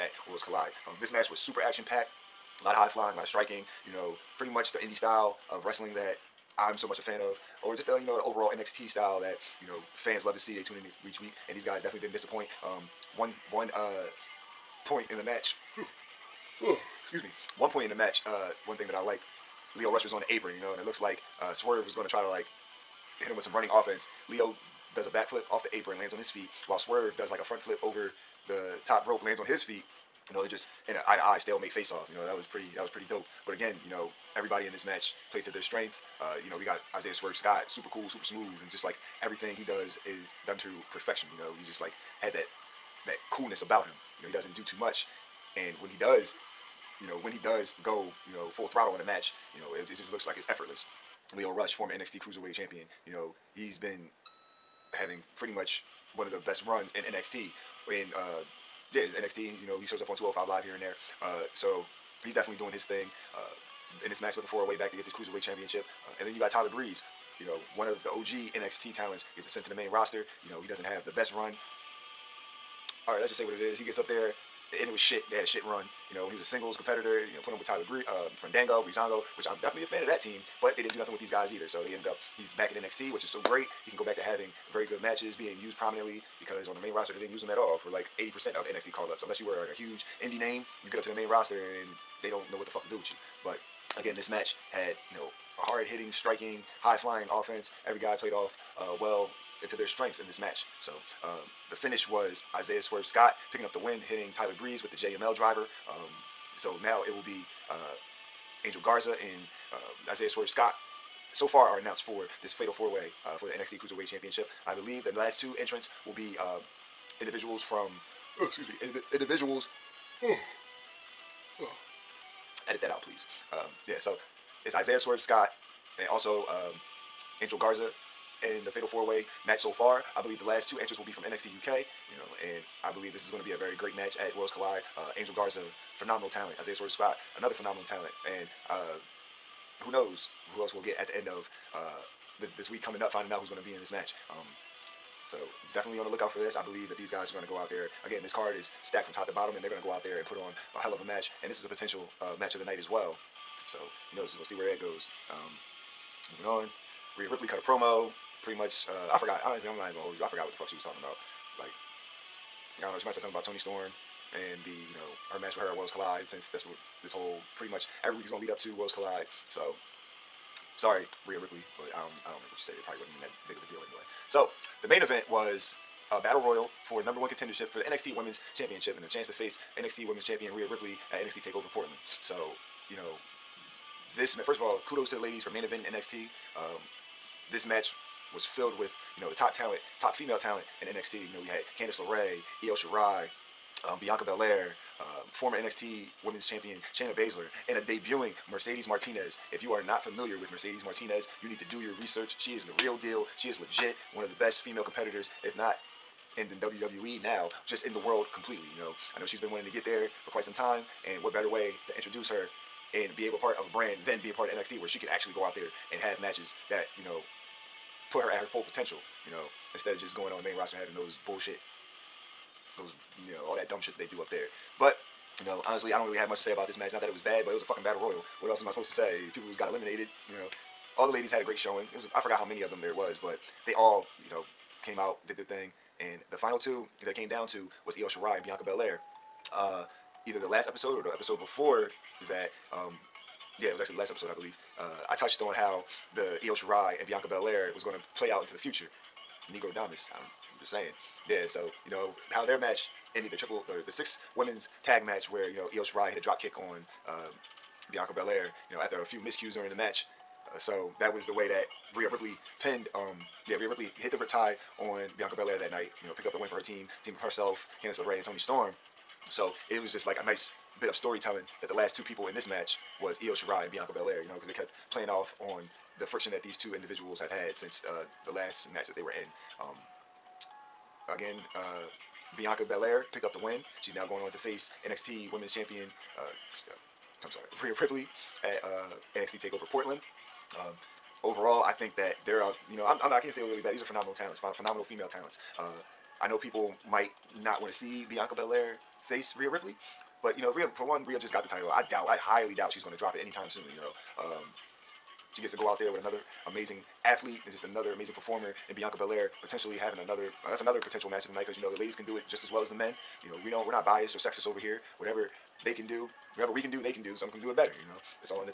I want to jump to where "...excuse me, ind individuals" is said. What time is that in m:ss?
1:58.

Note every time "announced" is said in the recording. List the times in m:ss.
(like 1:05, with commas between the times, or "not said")
1:51.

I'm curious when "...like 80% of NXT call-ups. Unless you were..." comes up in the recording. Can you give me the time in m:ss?
1:27.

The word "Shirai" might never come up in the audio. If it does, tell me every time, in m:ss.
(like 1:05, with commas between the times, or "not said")
3:12, 3:58, 4:06, 4:15, 4:33.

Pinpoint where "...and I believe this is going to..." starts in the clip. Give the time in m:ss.
2:12.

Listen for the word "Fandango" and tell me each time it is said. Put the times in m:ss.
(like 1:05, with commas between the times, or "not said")
1:18.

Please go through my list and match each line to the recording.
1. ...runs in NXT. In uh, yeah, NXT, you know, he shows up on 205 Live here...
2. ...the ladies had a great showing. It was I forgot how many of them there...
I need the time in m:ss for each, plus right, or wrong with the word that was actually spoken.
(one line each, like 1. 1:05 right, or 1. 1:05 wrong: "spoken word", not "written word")
1. 0:56 right
2. 3:51 right.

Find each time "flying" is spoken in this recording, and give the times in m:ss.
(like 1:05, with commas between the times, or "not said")
0:02, 1:36.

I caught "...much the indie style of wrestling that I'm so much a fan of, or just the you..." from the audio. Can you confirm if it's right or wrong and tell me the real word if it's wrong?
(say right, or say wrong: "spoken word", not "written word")
right.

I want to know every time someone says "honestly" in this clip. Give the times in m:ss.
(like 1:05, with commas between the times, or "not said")
2:39, 3:45.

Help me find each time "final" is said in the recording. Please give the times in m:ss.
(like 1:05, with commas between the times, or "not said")
3:56.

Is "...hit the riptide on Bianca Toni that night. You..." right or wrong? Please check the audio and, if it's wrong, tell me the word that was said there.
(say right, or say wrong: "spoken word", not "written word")
wrong: "Belair", not "Toni".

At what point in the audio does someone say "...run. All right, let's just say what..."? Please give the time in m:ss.
1:11.